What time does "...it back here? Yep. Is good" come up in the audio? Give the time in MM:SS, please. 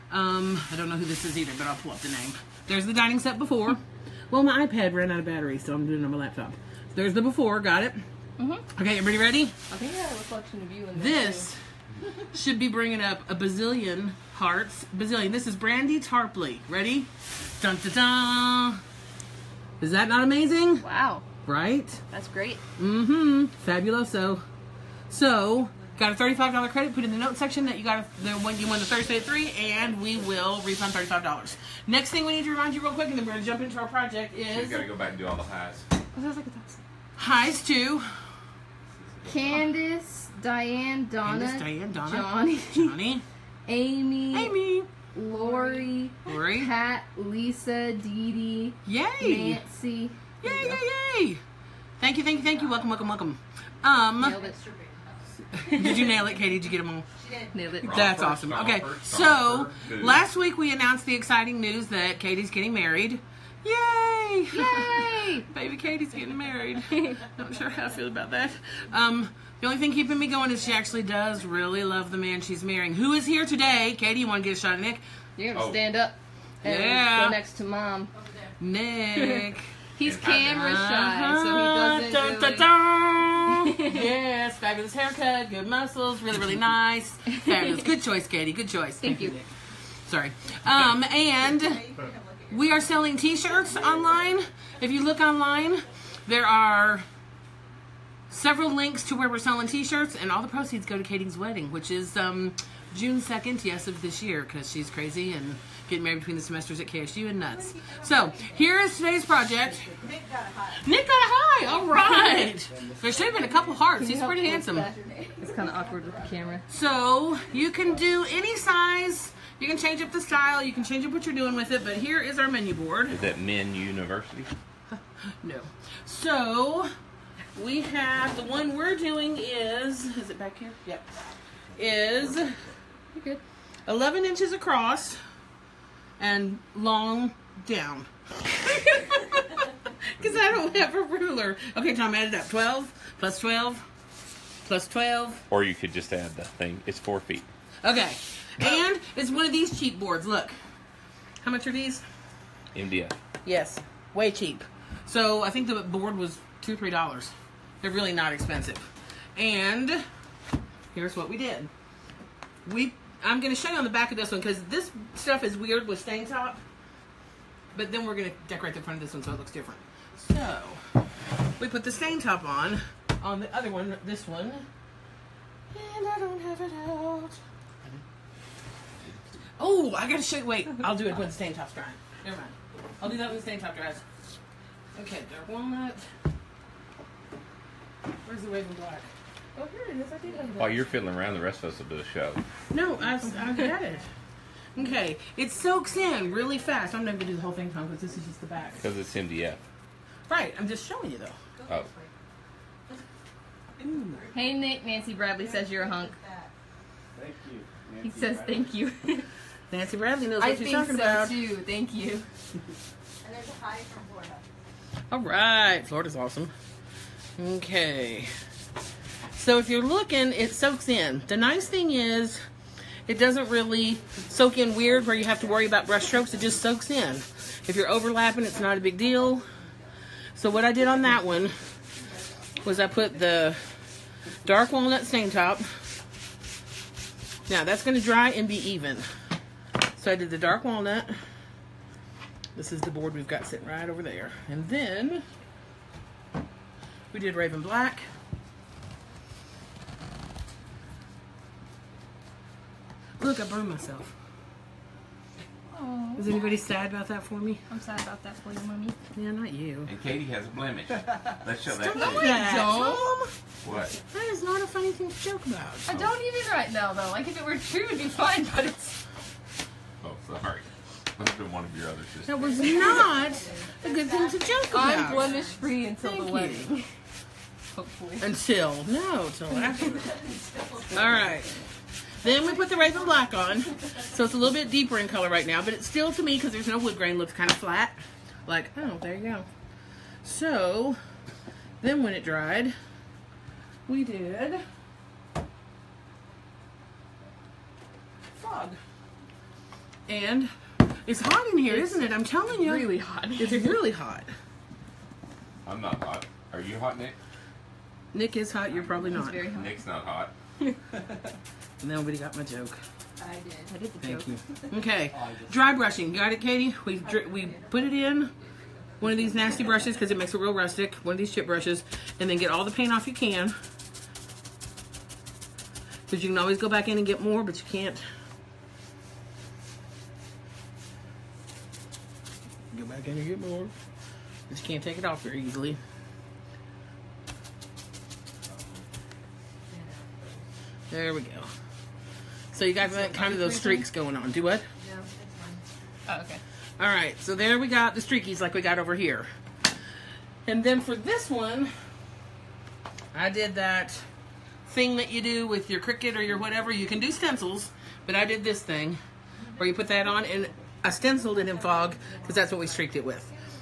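02:10.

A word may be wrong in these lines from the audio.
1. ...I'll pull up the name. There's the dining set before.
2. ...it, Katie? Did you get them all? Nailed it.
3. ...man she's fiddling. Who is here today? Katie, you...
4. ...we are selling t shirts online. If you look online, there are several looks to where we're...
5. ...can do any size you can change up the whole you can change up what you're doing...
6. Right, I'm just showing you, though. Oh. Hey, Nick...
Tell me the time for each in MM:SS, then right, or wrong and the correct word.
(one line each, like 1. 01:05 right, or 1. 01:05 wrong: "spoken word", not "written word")
1. 00:01 right
2. 00:56 right
3. 01:12 wrong: "marrying", not "fiddling"
4. 01:32 wrong: "links", not "looks"
5. 01:57 wrong: "style", not "whole"
6. 03:20 right.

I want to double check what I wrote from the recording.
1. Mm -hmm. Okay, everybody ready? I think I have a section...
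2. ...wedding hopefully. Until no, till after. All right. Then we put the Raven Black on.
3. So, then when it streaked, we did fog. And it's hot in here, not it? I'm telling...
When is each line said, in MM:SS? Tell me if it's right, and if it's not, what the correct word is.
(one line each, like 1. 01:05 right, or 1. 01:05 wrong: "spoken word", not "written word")
1. 00:08 wrong: "reflection", not "section"
2. 04:36 right
3. 04:50 wrong: "dried", not "streaked".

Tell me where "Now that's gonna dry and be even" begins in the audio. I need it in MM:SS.
03:57.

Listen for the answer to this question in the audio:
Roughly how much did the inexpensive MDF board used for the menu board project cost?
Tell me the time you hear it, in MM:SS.
02:36.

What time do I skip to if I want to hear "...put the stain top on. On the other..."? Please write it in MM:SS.
02:51.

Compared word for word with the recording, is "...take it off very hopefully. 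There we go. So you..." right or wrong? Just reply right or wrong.
wrong.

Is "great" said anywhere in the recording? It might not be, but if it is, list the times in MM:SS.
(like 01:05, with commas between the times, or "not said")
00:22.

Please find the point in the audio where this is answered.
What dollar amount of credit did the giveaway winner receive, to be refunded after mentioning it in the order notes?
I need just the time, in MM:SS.
00:26.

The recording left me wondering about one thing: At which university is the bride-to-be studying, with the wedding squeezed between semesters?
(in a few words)
KSU.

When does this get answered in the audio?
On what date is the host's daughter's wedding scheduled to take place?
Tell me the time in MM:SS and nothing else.
01:42.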